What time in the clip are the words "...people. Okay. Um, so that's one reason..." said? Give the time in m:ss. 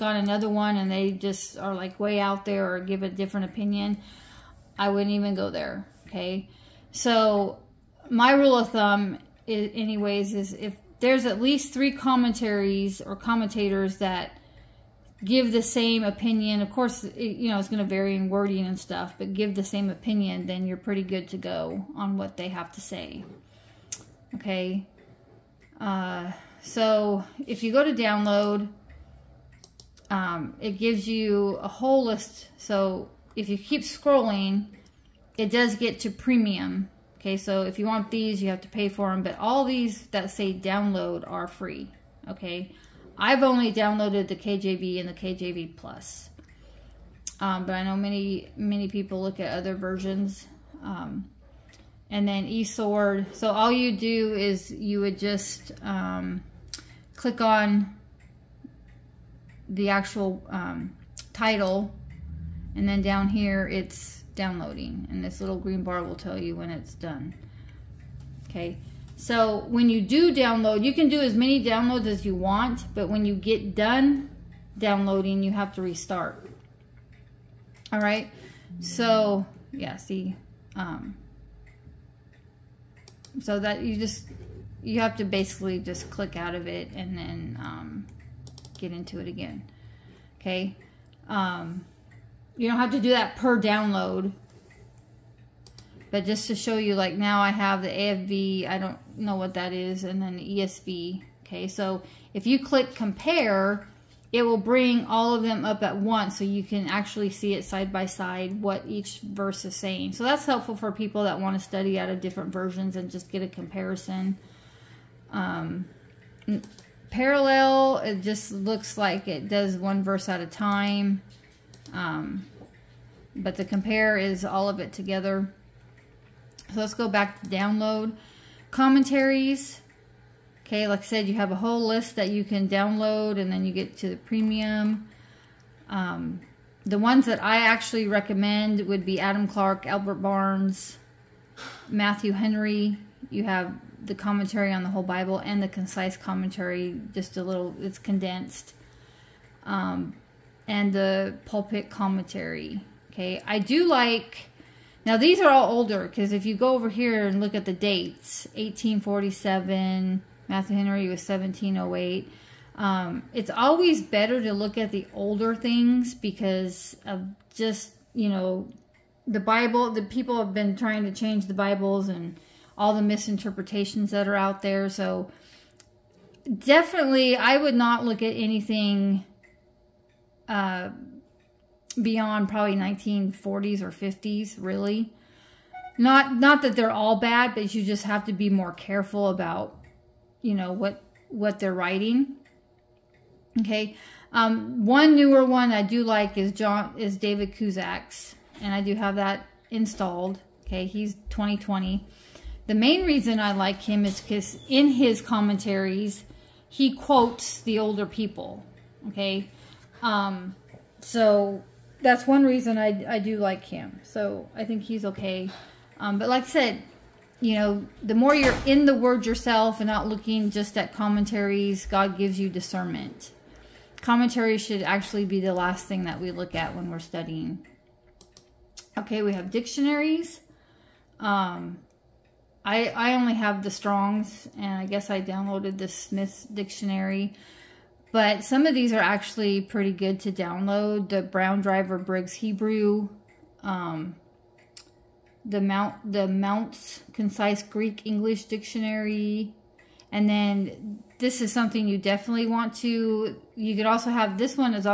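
3:28.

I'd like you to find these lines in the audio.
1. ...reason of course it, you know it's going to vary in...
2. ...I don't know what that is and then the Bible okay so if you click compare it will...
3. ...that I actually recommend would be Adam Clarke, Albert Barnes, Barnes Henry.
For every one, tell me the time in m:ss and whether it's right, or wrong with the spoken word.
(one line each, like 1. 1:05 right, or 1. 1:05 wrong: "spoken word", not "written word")
1. 0:16 wrong: "opinion", not "reason"
2. 1:38 wrong: "ESV", not "Bible"
3. 2:17 wrong: "Matthew", not "Barnes".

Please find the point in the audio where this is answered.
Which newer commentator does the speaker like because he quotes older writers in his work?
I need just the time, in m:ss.
3:17.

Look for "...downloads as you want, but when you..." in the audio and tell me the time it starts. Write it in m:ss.
1:11.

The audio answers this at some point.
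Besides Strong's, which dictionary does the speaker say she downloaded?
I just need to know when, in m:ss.
3:55.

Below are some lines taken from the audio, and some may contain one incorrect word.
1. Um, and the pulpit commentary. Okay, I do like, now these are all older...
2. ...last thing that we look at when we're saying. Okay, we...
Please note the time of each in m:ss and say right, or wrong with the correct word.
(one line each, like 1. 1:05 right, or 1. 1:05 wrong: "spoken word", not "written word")
1. 2:29 right
2. 3:45 wrong: "studying", not "saying".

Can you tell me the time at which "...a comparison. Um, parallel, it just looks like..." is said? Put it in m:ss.
1:53.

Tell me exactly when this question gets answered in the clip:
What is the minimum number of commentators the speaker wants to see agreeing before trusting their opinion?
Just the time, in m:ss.
0:11.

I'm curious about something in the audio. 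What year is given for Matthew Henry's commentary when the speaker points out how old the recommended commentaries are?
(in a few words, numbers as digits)
1708.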